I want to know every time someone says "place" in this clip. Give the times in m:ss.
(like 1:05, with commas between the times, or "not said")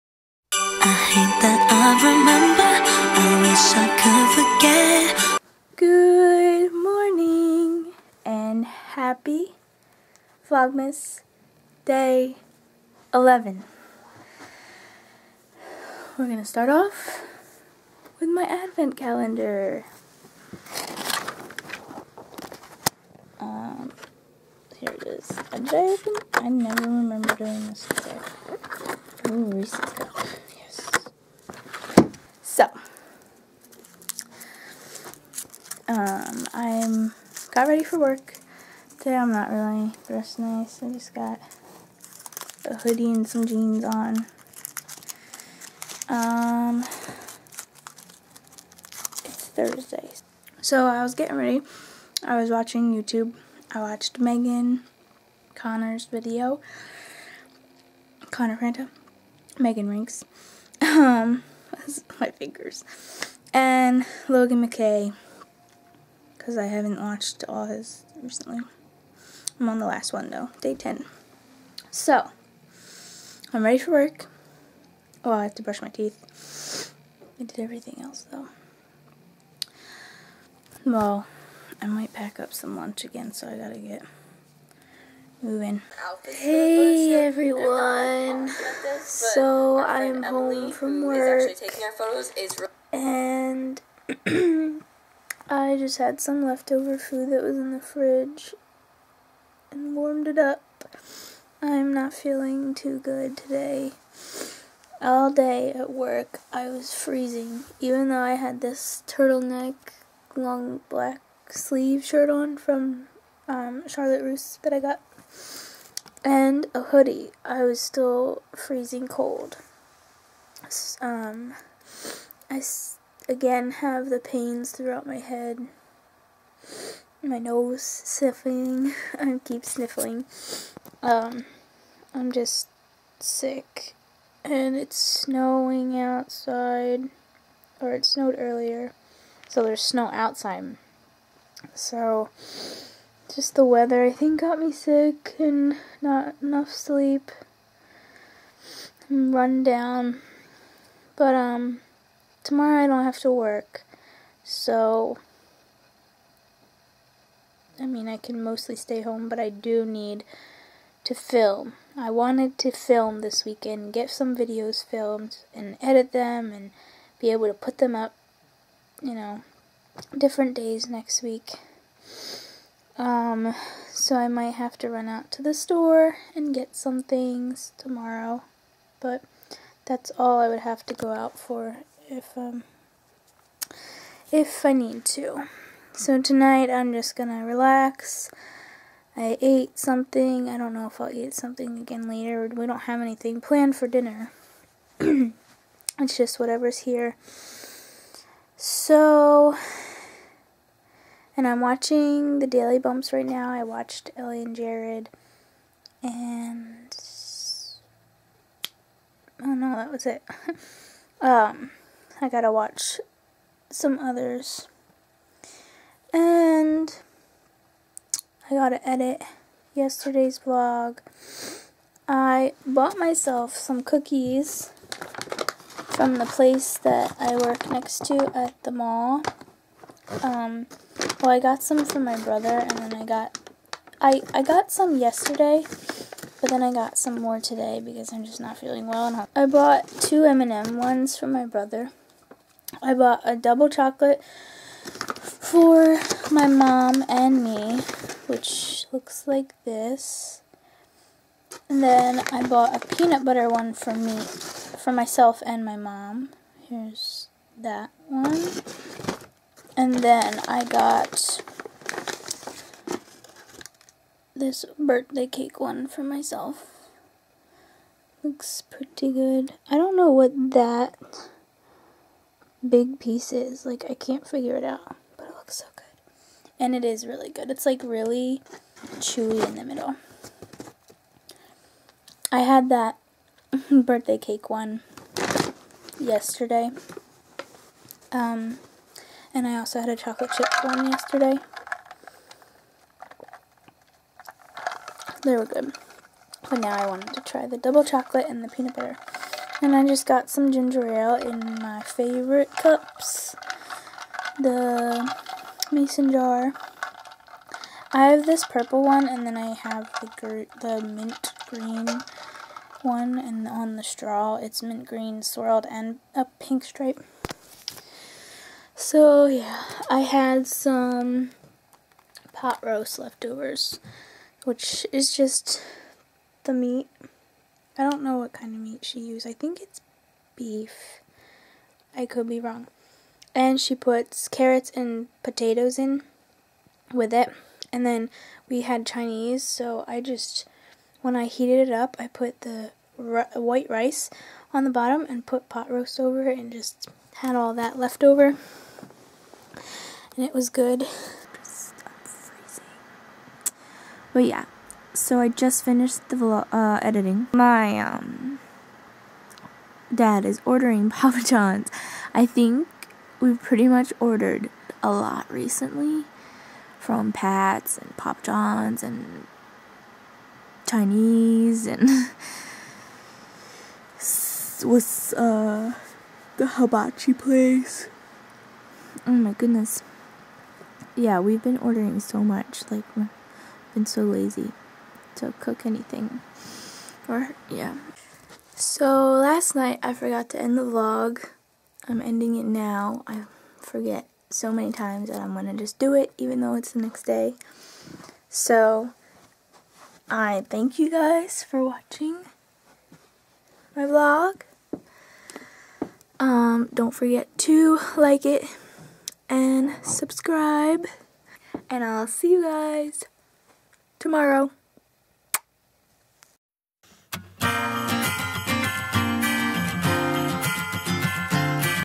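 3:46, 6:17.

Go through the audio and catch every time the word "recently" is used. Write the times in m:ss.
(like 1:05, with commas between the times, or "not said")
1:08, 6:05.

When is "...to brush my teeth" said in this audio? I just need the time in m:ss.
1:15.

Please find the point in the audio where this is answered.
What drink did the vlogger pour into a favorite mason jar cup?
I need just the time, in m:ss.
5:00.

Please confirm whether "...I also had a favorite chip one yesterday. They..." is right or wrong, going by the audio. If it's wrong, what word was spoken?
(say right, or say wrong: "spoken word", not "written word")
wrong: "chocolate", not "favorite".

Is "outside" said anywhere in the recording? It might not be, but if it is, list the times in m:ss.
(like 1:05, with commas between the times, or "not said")
2:15, 2:20.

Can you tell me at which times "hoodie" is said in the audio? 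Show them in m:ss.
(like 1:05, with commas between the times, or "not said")
0:42, 1:56.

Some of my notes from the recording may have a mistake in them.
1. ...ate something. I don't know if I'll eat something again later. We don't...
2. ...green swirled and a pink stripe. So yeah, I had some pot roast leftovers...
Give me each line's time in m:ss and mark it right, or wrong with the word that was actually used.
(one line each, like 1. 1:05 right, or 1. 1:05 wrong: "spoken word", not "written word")
1. 3:09 right
2. 5:14 right.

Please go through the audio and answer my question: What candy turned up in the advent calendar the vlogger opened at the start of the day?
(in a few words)
Reese's.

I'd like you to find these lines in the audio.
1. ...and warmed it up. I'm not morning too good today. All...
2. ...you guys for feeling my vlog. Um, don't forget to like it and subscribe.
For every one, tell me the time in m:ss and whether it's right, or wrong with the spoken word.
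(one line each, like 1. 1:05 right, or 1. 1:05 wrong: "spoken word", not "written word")
1. 1:39 wrong: "feeling", not "morning"
2. 6:40 wrong: "watching", not "feeling".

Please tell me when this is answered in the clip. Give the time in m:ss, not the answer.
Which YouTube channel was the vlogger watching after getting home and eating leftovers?
3:22.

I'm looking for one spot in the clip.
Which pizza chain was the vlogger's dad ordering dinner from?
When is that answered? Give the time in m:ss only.
6:00.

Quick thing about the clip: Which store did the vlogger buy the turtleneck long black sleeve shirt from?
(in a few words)
Charlotte Russe.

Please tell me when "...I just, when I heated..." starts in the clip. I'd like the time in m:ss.
5:39.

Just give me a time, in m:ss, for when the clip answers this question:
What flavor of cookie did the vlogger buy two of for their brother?
4:00.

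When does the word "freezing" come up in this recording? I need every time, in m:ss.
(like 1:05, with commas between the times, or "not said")
1:46, 1:58.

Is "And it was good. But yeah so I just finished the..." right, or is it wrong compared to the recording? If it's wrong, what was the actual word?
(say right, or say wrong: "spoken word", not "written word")
right.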